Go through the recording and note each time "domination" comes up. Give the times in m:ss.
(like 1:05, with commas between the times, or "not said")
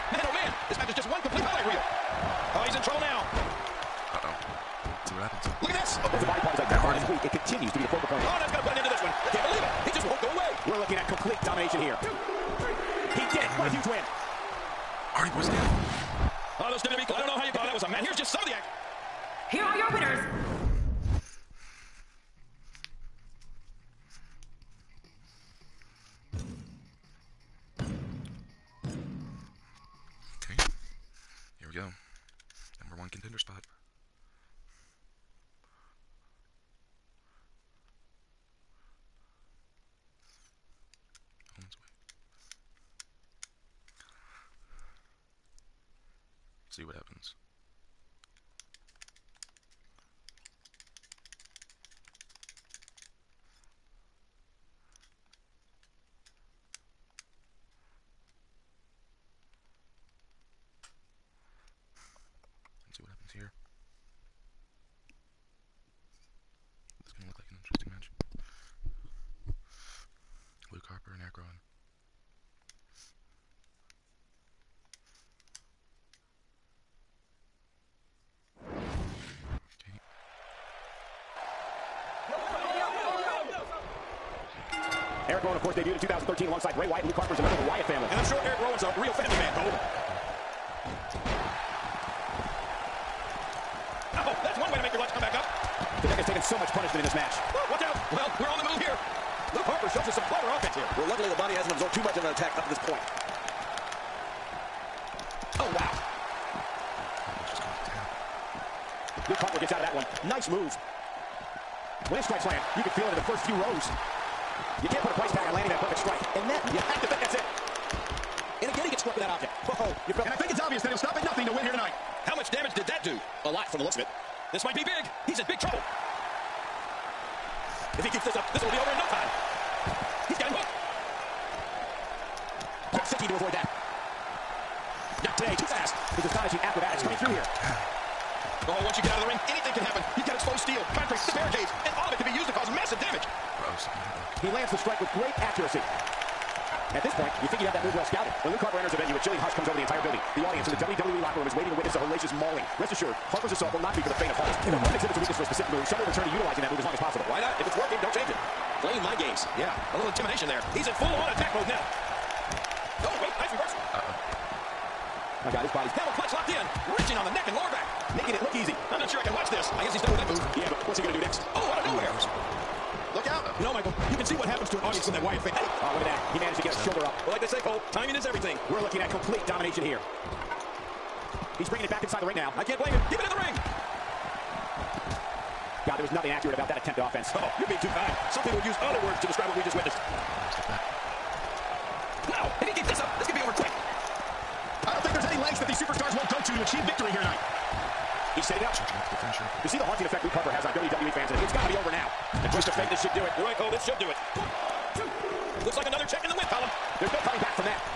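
0:11, 2:59.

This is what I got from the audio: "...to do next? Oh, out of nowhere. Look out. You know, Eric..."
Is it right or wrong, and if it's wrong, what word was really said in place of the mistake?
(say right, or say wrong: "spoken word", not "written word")
wrong: "Michael", not "Eric".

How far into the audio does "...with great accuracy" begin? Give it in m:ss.
2:25.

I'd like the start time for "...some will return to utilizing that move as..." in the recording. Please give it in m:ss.
2:35.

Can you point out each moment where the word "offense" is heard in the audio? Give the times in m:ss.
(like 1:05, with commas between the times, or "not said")
1:40, 3:07.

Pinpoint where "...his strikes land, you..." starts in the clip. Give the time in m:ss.
1:52.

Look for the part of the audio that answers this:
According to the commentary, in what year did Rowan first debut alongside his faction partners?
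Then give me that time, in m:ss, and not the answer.
1:25.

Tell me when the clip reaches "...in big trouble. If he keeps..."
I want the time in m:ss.
2:05.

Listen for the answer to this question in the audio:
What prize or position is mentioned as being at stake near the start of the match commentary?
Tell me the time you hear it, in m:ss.
0:32.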